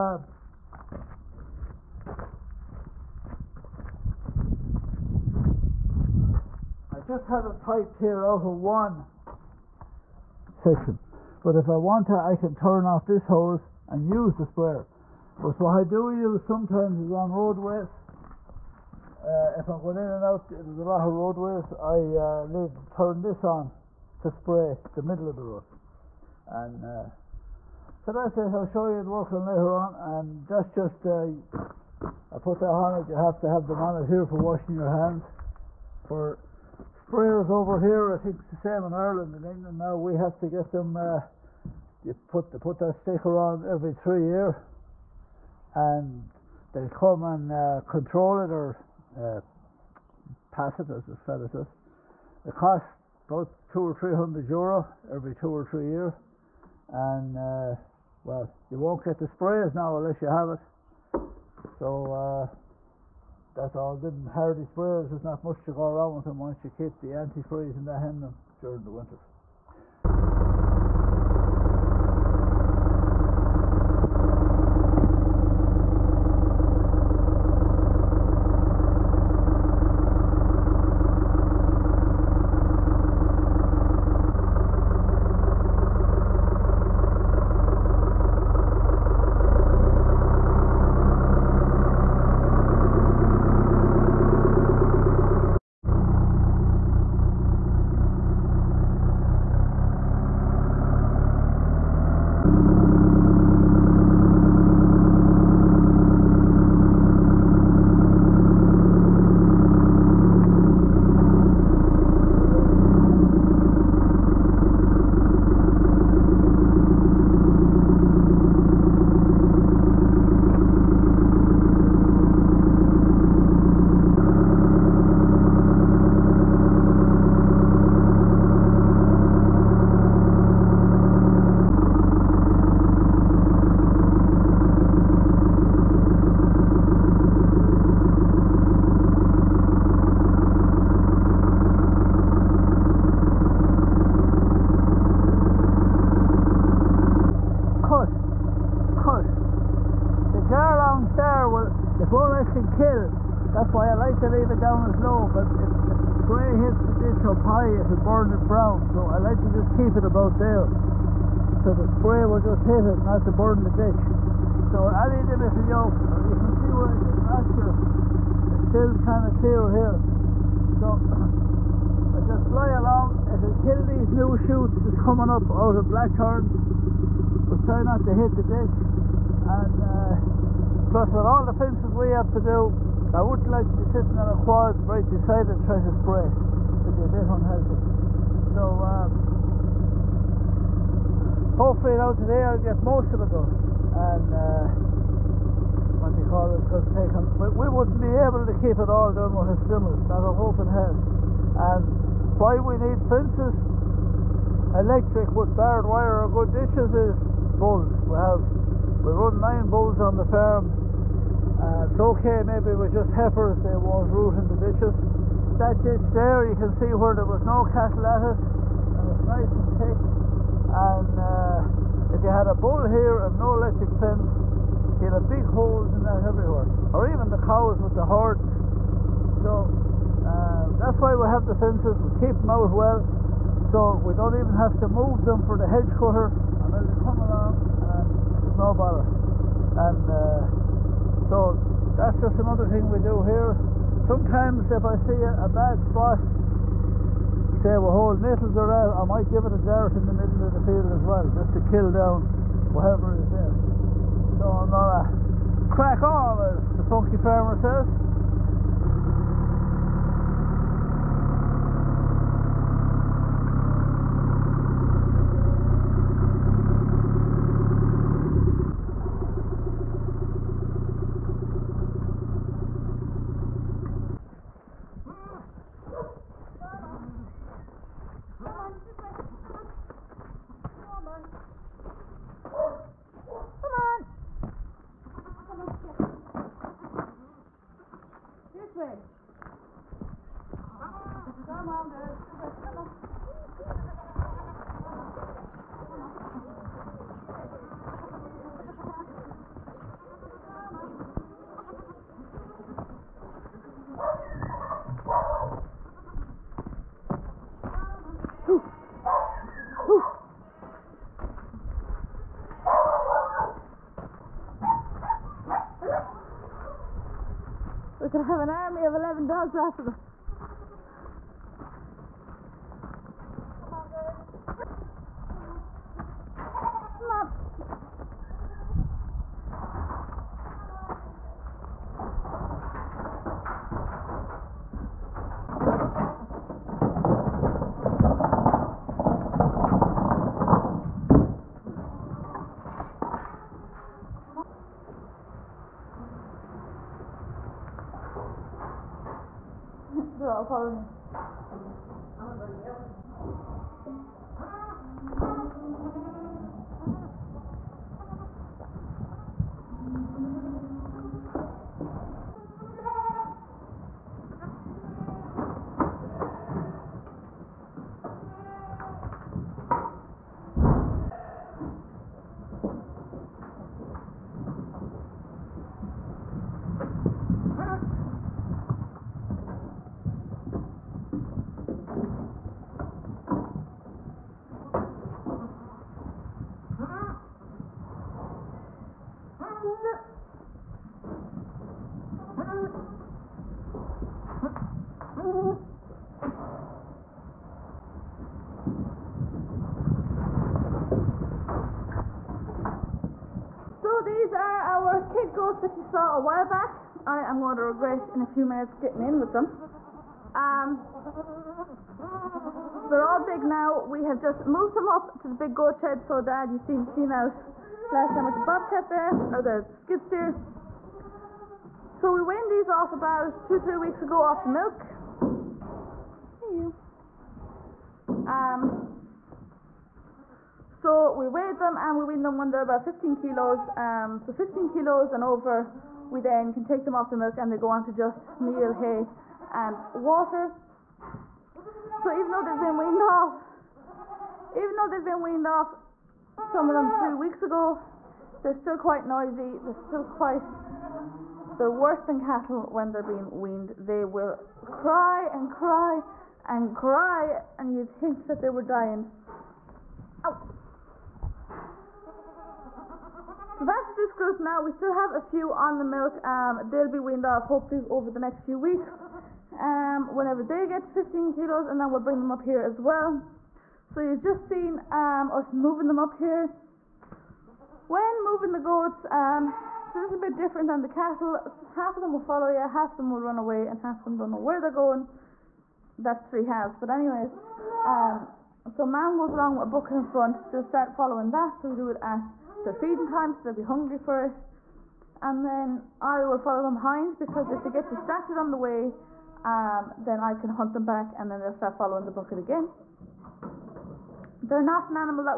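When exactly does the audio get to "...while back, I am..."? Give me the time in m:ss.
6:46.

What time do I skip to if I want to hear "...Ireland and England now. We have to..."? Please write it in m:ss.
0:38.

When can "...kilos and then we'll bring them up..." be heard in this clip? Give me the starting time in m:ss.
7:51.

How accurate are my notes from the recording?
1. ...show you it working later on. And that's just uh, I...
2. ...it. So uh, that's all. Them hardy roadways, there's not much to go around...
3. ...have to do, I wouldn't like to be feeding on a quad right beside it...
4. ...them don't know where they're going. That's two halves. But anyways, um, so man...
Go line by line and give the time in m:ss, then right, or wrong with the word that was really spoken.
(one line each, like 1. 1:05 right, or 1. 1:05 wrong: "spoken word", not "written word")
1. 0:28 right
2. 1:00 wrong: "sprays", not "roadways"
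3. 3:02 wrong: "sitting", not "feeding"
4. 8:04 wrong: "three", not "two".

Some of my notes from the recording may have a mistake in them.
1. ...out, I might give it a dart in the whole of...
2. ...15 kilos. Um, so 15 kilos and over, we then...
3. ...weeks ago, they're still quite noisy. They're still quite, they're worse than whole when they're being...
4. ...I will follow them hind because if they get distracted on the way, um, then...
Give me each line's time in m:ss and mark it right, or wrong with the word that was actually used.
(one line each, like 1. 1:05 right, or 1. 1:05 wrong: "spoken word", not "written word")
1. 4:08 wrong: "middle", not "whole"
2. 7:12 right
3. 7:27 wrong: "cattle", not "whole"
4. 8:16 right.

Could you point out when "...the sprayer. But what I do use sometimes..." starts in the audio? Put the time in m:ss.
0:14.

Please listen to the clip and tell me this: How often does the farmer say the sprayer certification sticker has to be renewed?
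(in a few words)
every 3 years.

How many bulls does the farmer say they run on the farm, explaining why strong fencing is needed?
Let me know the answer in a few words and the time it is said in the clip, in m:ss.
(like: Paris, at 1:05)
9, at 3:29.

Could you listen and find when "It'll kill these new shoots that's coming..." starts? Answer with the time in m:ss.
2:53.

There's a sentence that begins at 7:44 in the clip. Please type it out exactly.
We still have a few on the milk.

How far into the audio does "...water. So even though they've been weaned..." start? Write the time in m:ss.
7:20.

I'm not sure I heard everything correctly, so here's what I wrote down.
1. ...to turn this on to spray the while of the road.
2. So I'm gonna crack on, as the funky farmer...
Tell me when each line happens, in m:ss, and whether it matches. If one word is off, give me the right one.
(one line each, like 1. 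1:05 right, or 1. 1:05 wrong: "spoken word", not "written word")
1. 0:22 wrong: "middle", not "while"
2. 4:14 right.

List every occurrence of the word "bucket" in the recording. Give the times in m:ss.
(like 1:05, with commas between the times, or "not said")
8:09, 8:22.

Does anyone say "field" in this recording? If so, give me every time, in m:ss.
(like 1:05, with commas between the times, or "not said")
4:10.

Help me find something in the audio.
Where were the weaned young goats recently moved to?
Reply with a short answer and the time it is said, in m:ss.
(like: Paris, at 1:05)
the big goat shed, at 6:55.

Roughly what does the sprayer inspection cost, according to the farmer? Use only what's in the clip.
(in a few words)
200 to 300 euro.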